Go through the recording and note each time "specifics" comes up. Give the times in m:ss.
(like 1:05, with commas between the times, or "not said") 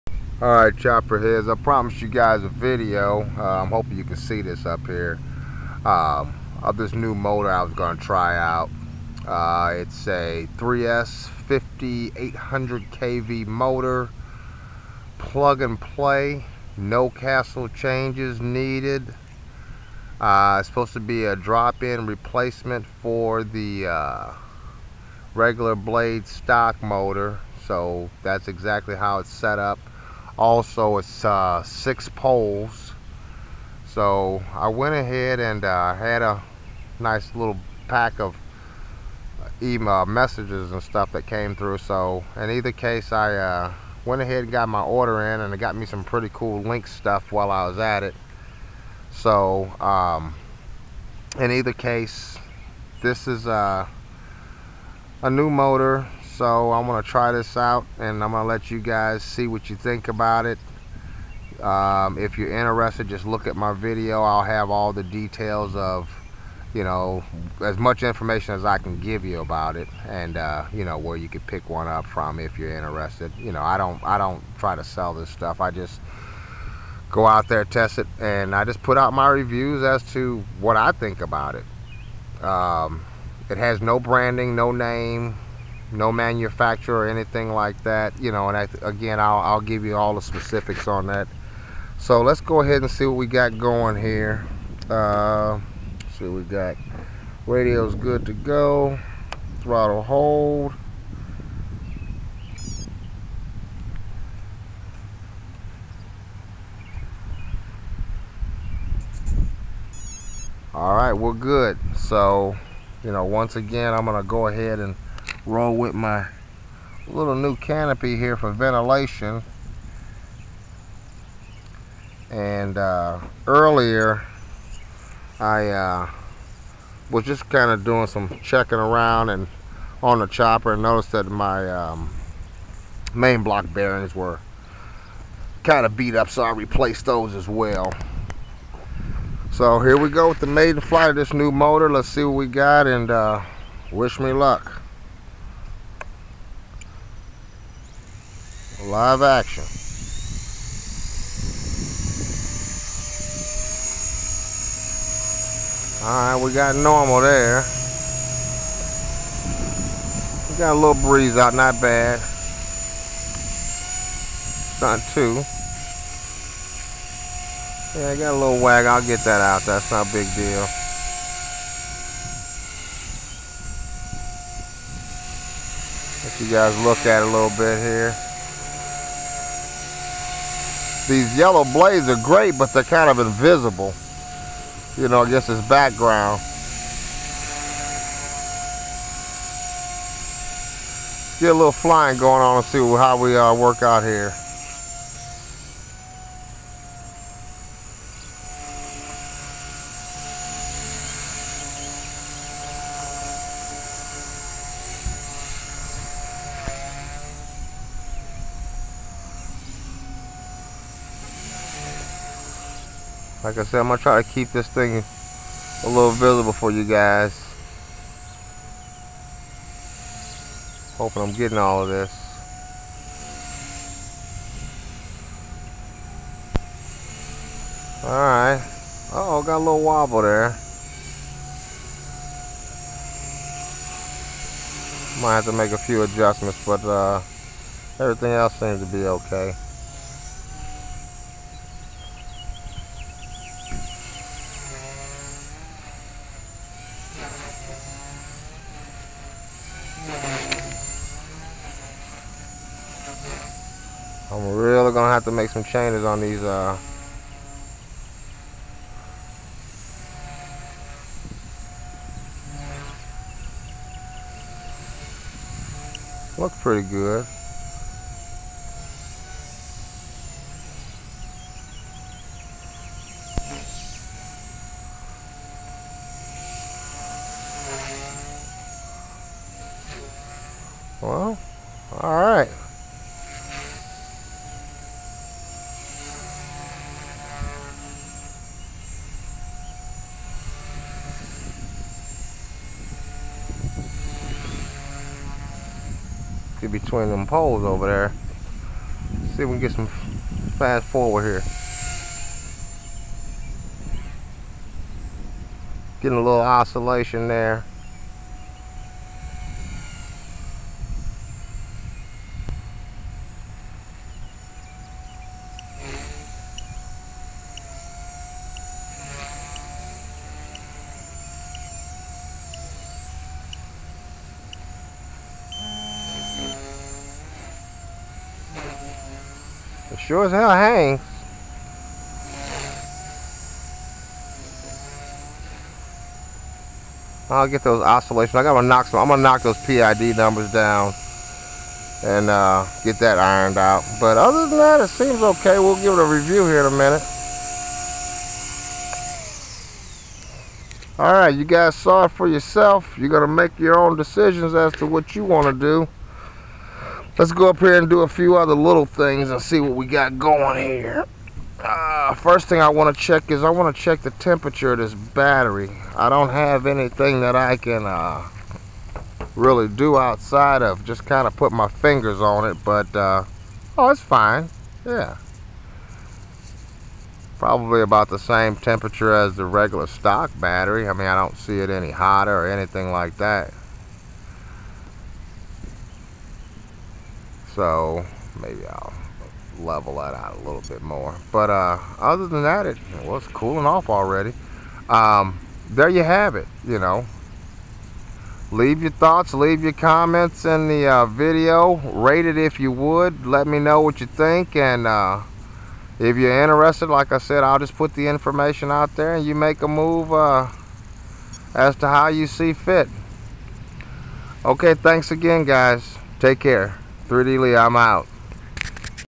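1:30.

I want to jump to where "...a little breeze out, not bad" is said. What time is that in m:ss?
2:40.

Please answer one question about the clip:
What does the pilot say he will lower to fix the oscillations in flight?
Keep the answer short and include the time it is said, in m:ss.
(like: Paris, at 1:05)
PID numbers, at 5:39.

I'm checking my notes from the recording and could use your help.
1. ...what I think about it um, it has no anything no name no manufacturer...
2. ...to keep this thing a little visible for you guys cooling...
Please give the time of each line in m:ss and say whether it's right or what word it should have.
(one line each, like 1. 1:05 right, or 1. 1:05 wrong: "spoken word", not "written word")
1. 1:20 wrong: "branding", not "anything"
2. 3:34 wrong: "hoping", not "cooling".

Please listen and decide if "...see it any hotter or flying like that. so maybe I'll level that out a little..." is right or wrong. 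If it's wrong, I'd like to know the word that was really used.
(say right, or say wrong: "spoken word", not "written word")
wrong: "anything", not "flying".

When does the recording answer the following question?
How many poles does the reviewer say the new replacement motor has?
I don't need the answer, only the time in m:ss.
0:31.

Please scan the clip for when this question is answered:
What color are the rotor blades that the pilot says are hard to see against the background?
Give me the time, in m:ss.
3:01.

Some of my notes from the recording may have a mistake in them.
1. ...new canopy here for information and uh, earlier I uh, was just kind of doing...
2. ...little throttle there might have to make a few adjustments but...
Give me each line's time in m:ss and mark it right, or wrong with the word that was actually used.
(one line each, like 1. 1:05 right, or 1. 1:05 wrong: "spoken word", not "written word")
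1. 1:57 wrong: "ventilation", not "information"
2. 3:49 wrong: "wobble", not "throttle".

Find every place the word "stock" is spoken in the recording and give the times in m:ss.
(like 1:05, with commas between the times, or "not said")
0:26, 6:19.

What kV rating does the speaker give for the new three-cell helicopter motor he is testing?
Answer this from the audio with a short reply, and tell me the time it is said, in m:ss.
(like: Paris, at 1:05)
5800, at 0:11.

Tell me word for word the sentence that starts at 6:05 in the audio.
I don't have anything that I can uh, really do outside of.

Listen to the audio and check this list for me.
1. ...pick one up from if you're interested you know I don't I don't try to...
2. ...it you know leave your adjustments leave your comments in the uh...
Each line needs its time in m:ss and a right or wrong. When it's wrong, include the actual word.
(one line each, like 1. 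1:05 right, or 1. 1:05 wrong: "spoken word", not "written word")
1. 1:11 right
2. 6:36 wrong: "thoughts", not "adjustments".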